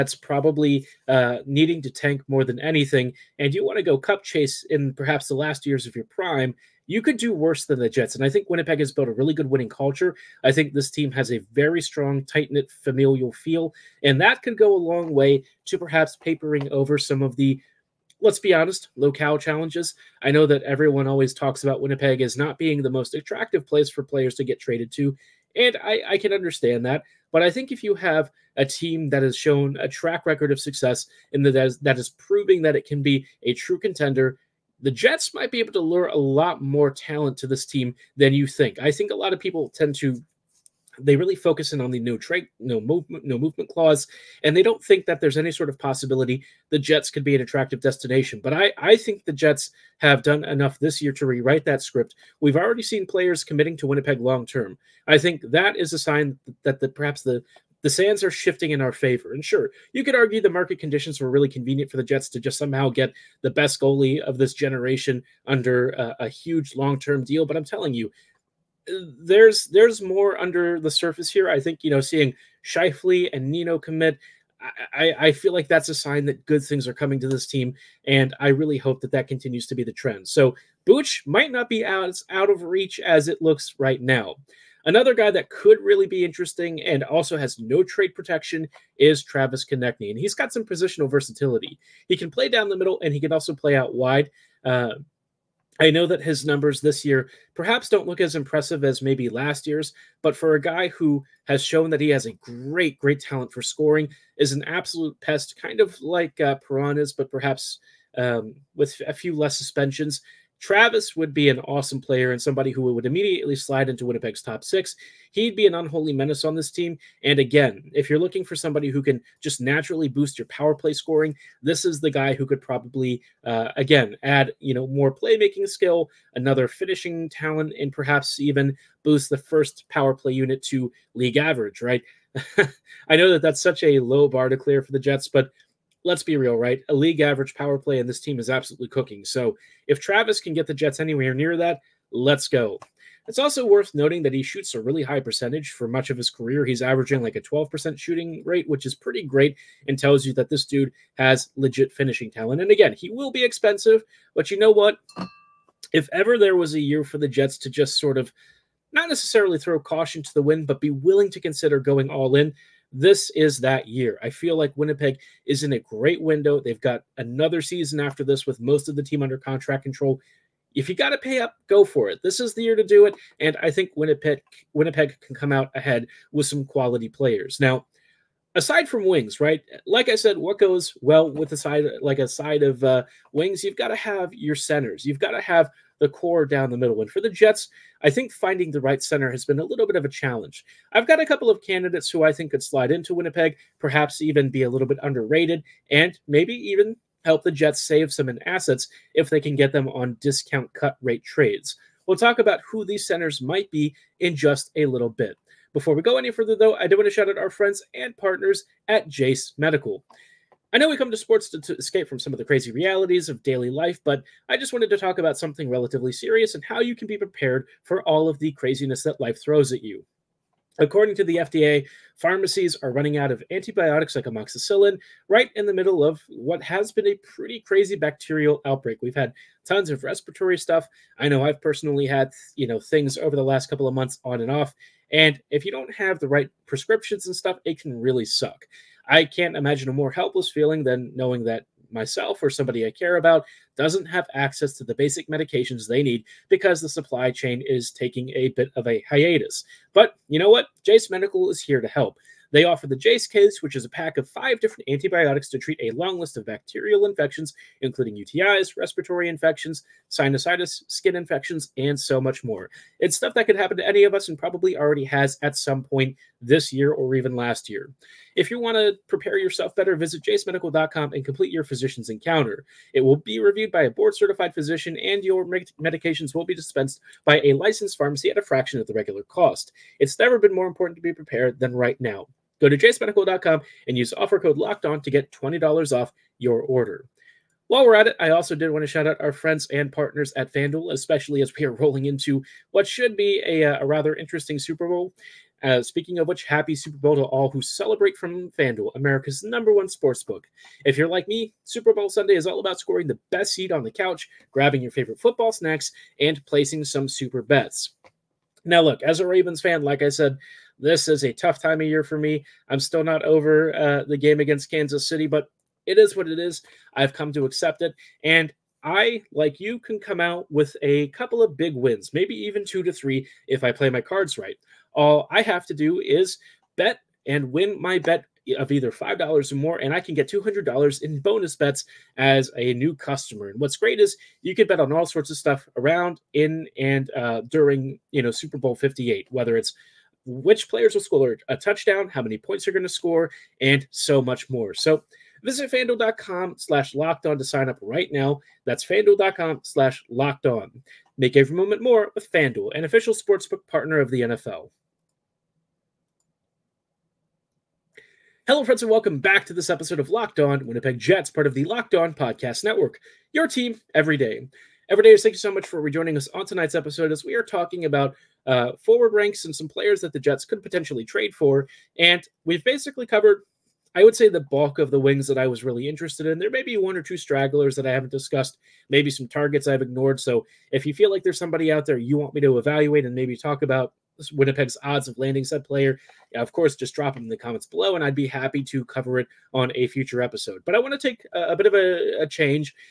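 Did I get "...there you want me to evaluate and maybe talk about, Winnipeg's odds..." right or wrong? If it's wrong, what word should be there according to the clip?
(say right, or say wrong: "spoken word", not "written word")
right.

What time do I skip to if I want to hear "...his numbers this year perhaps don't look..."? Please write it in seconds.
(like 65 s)
96 s.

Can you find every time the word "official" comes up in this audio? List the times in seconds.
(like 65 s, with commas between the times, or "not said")
352 s.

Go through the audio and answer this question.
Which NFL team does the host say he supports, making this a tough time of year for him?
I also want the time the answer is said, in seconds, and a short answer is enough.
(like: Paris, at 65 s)
Ravens, at 309 s.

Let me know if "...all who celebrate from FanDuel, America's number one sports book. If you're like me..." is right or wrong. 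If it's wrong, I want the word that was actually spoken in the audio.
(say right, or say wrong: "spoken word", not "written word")
right.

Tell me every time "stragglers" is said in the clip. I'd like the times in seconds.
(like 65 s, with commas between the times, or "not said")
377 s.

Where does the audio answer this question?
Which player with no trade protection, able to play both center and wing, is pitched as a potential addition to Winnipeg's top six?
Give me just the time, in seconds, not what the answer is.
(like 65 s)
89 s.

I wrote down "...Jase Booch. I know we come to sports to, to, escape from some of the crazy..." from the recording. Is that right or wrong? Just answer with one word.
wrong.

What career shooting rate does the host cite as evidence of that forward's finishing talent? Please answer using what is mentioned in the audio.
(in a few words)
12%.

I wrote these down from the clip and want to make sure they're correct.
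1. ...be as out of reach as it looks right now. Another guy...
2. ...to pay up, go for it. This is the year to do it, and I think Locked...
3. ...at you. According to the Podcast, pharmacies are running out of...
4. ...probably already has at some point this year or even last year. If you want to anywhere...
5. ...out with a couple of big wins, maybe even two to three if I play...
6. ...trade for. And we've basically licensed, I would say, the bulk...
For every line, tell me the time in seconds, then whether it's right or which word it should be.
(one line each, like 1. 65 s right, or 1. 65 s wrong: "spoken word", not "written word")
1. 81 s right
2. 171 s wrong: "Winnipeg", not "Locked"
3. 219 s wrong: "FDA", not "Podcast"
4. 264 s wrong: "prepare", not "anywhere"
5. 320 s right
6. 371 s wrong: "covered", not "licensed".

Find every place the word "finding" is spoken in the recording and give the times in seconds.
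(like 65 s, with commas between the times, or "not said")
188 s.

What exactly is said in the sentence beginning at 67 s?
But I'm telling you, there's there's more under the surface here.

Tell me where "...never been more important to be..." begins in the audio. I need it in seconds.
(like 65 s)
280 s.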